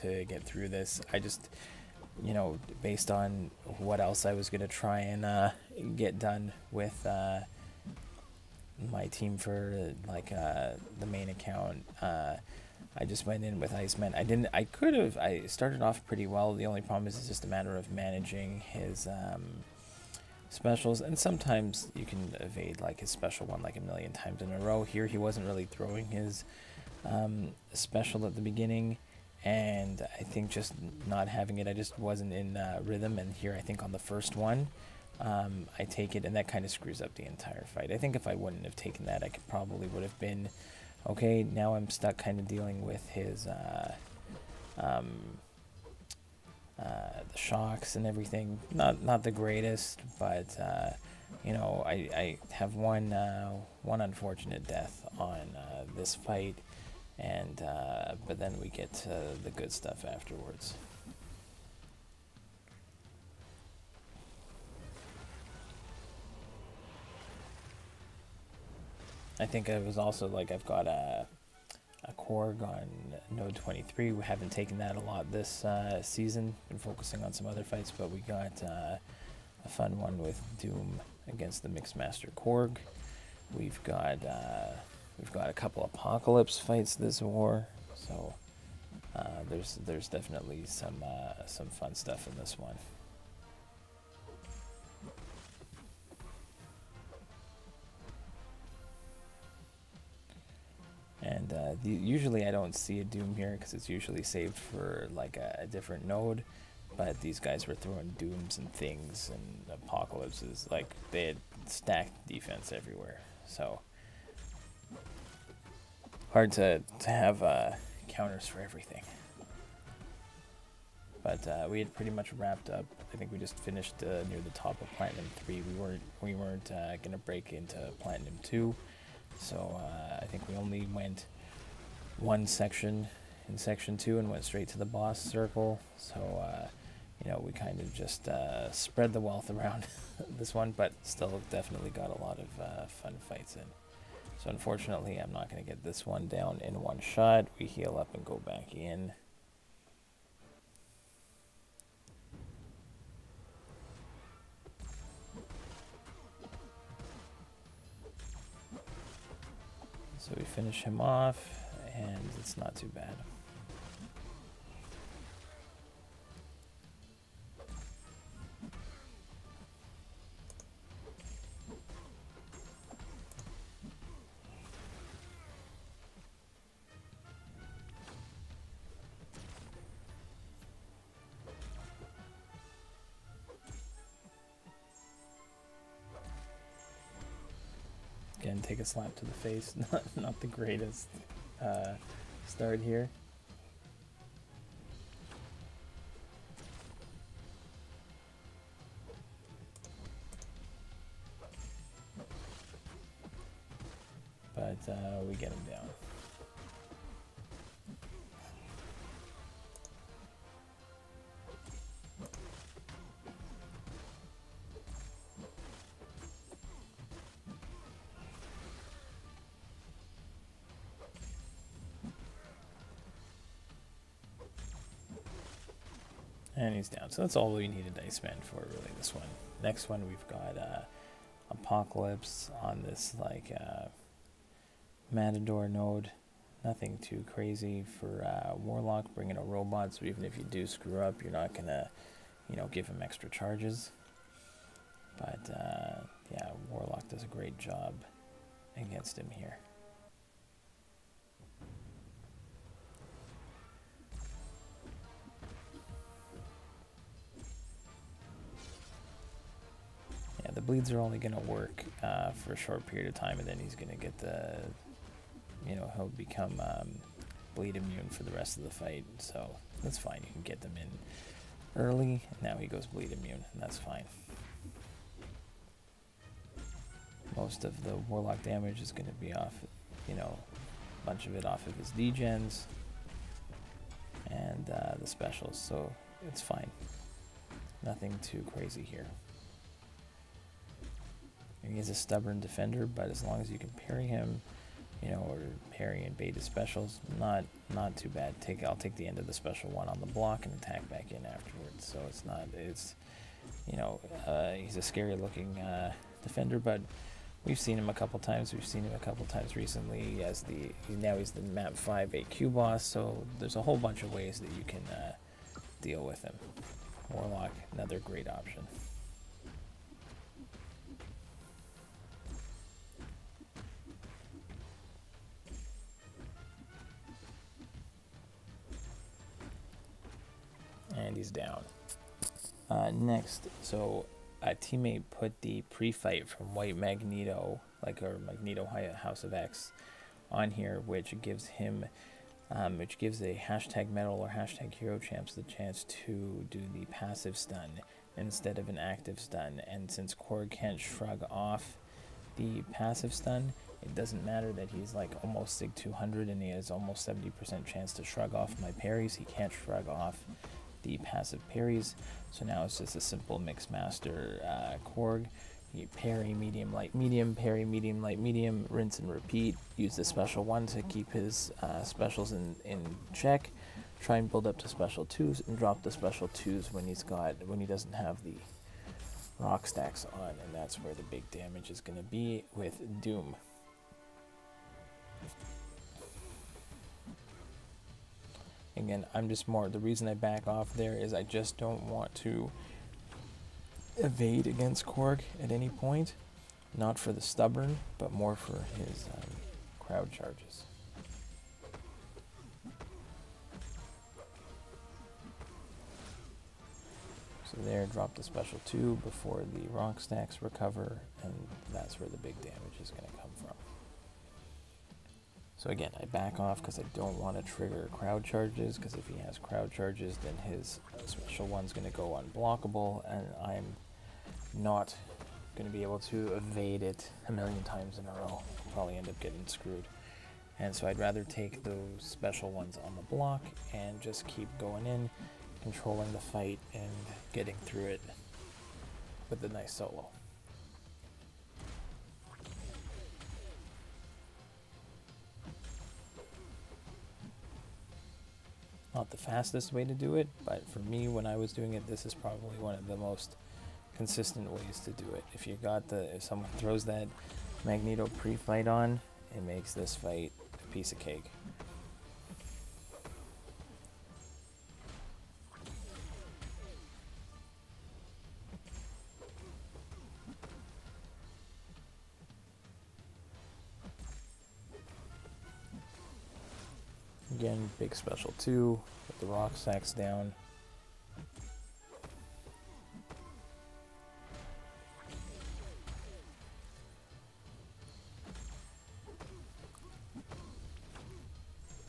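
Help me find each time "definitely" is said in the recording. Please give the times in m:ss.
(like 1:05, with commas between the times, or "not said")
1:30, 2:21.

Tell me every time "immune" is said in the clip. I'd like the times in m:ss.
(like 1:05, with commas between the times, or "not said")
4:27, 4:33.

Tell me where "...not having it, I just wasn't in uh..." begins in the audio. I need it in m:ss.
0:31.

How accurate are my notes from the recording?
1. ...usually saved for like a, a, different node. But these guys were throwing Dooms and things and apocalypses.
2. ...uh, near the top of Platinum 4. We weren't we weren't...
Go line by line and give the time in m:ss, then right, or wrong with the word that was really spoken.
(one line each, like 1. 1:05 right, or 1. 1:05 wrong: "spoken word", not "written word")
1. 1:43 right
2. 2:04 wrong: "3", not "4".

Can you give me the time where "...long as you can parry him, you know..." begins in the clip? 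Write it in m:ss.
4:53.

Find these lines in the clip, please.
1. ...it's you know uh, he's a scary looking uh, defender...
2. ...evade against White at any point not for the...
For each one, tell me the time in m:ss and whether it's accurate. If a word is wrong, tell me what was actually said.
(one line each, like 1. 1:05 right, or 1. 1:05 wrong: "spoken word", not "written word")
1. 5:02 right
2. 6:33 wrong: "Korg", not "White".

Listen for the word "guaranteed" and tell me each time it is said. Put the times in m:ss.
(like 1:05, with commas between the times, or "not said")
not said.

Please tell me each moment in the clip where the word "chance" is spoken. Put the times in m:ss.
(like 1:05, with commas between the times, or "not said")
5:45, 5:57.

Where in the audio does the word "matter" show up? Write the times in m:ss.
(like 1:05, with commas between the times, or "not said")
0:17, 5:54.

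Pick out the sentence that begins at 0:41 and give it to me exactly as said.
Now I'm stuck kind of dealing with his uh, um, uh, the shocks and everything.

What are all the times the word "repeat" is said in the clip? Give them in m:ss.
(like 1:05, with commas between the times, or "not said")
6:09.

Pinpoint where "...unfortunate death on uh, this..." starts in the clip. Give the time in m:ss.
0:53.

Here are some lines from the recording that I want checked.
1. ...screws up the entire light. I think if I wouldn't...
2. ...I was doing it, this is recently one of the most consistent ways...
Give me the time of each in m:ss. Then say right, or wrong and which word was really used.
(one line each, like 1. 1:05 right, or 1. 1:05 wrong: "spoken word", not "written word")
1. 0:36 wrong: "fight", not "light"
2. 7:31 wrong: "probably", not "recently".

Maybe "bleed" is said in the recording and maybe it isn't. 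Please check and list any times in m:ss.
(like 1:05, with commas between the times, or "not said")
4:20, 4:27, 4:32.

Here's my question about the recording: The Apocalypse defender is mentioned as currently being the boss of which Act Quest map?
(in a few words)
map five.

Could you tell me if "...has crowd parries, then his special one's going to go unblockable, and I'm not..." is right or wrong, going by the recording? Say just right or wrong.
wrong.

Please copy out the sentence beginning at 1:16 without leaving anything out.
Been focusing on some other fights, but we got uh, a fun one with Doom against the Mixmaster Korg.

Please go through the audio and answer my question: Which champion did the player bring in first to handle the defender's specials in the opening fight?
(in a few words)
Iceman.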